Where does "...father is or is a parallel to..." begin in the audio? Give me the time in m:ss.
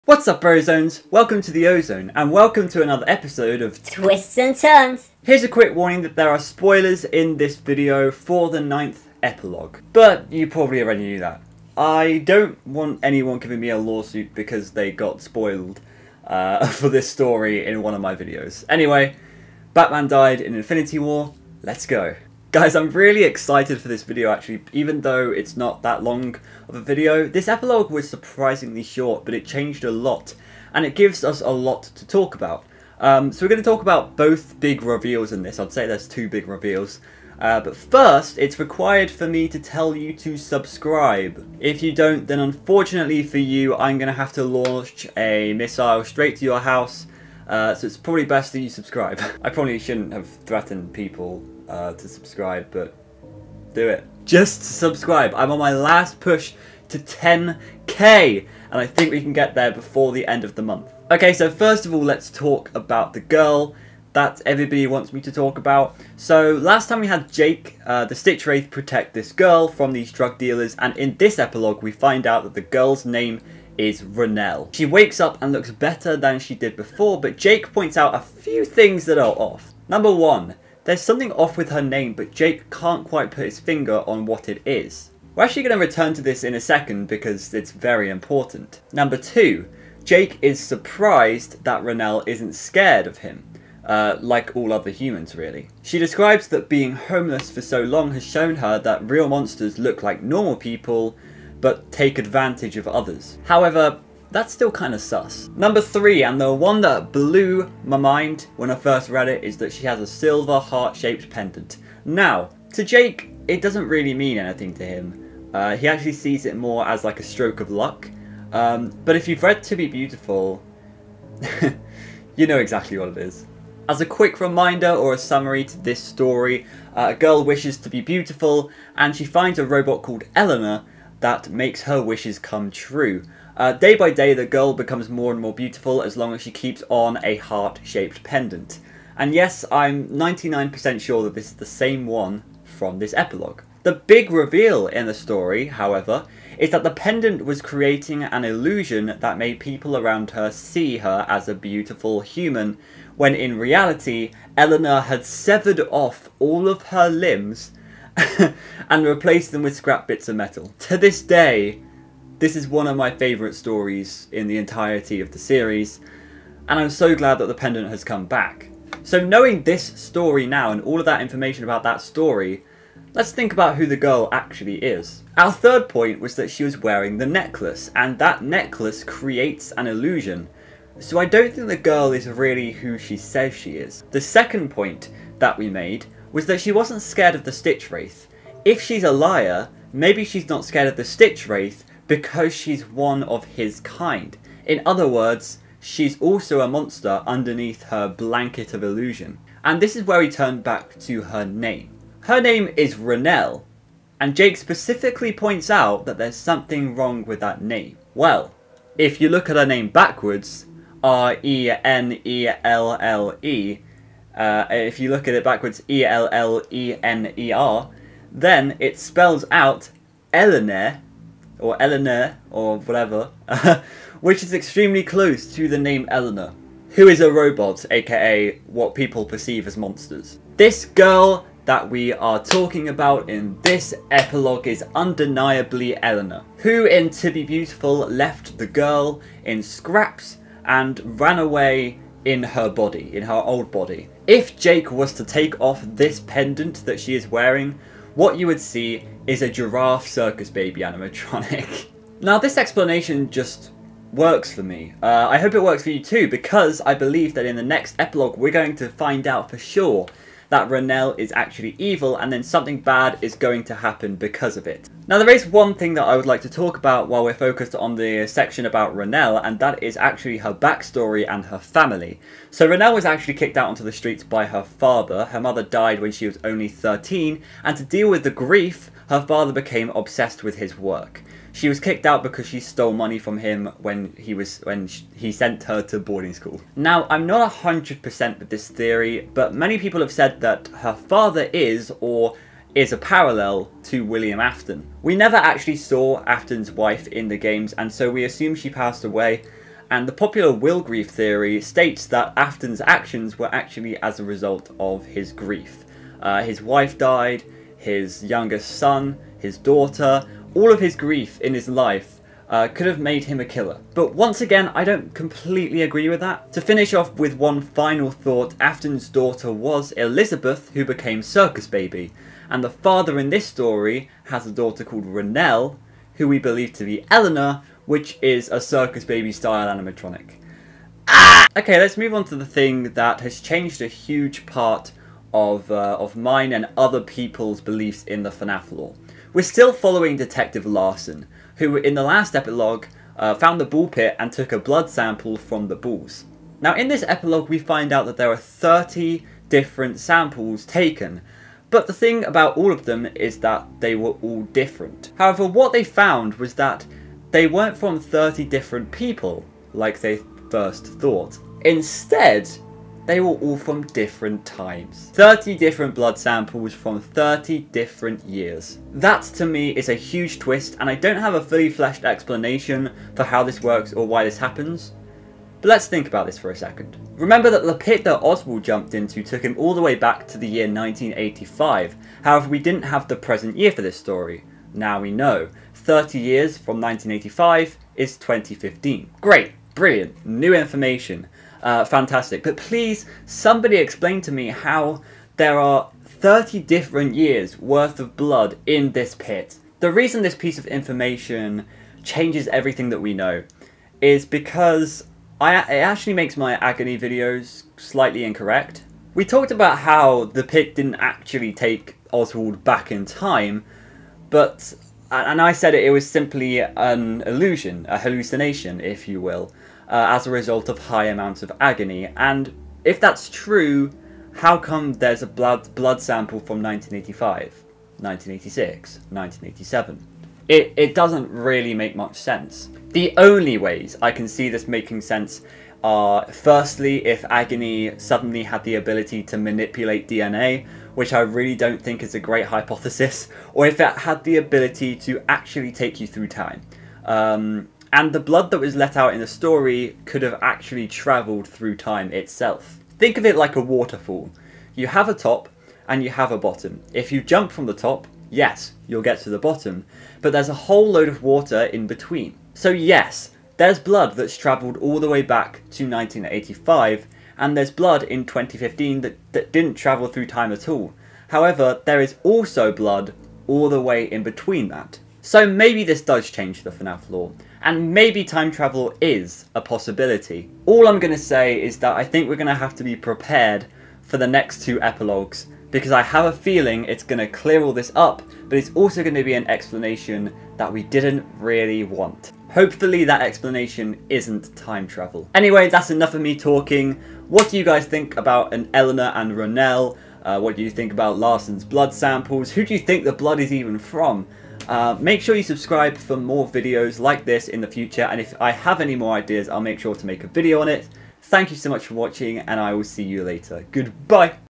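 4:50.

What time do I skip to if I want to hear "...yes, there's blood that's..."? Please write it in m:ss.
7:42.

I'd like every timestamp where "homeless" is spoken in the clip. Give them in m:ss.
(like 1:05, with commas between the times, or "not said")
1:36.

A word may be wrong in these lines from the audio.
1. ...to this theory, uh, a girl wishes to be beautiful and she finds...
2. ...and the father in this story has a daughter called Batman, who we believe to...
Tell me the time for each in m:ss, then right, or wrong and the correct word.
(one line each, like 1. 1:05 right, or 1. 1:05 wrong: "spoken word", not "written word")
1. 2:05 wrong: "story", not "theory"
2. 5:22 wrong: "Renelle", not "Batman".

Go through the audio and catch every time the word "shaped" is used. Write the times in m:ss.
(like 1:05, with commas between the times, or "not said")
1:50, 2:17.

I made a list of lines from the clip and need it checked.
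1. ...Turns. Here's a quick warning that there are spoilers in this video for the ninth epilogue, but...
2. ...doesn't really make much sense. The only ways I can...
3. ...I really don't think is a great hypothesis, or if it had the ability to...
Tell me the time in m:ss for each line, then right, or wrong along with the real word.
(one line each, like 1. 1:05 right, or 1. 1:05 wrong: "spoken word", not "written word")
1. 0:04 right
2. 7:10 right
3. 7:21 right.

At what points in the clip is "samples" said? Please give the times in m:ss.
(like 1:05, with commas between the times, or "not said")
5:44, 5:50, 6:06, 7:06, 8:21.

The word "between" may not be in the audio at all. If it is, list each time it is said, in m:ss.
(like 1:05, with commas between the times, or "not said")
7:41, 7:54.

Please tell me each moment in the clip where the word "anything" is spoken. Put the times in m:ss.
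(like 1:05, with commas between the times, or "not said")
1:54.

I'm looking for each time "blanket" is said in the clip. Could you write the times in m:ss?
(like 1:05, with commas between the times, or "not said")
3:18.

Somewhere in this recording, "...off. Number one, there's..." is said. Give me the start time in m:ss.
1:19.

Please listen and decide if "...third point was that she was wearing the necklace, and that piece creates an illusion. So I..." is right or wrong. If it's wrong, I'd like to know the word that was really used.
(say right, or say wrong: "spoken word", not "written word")
wrong: "necklace", not "piece".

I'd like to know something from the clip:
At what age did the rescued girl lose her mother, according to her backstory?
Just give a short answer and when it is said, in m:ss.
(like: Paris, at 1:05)
13, at 4:36.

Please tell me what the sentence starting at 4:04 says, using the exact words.
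If Jake was to take off this pendant that she is wearing, what you would see is a giraffe circus baby animatronic.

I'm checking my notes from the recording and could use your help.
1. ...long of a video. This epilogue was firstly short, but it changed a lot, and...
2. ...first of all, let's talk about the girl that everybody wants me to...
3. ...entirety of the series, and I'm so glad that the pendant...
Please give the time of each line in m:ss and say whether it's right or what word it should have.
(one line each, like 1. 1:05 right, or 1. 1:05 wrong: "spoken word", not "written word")
1. 0:26 wrong: "surprisingly", not "firstly"
2. 1:01 right
3. 2:44 right.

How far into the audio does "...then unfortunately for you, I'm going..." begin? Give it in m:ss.
0:42.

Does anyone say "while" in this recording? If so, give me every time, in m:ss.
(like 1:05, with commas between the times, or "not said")
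4:27.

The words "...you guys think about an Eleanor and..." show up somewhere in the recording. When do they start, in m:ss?
8:17.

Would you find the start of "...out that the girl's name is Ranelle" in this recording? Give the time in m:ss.
1:12.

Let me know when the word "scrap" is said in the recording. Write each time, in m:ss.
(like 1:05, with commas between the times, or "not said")
2:39, 3:59.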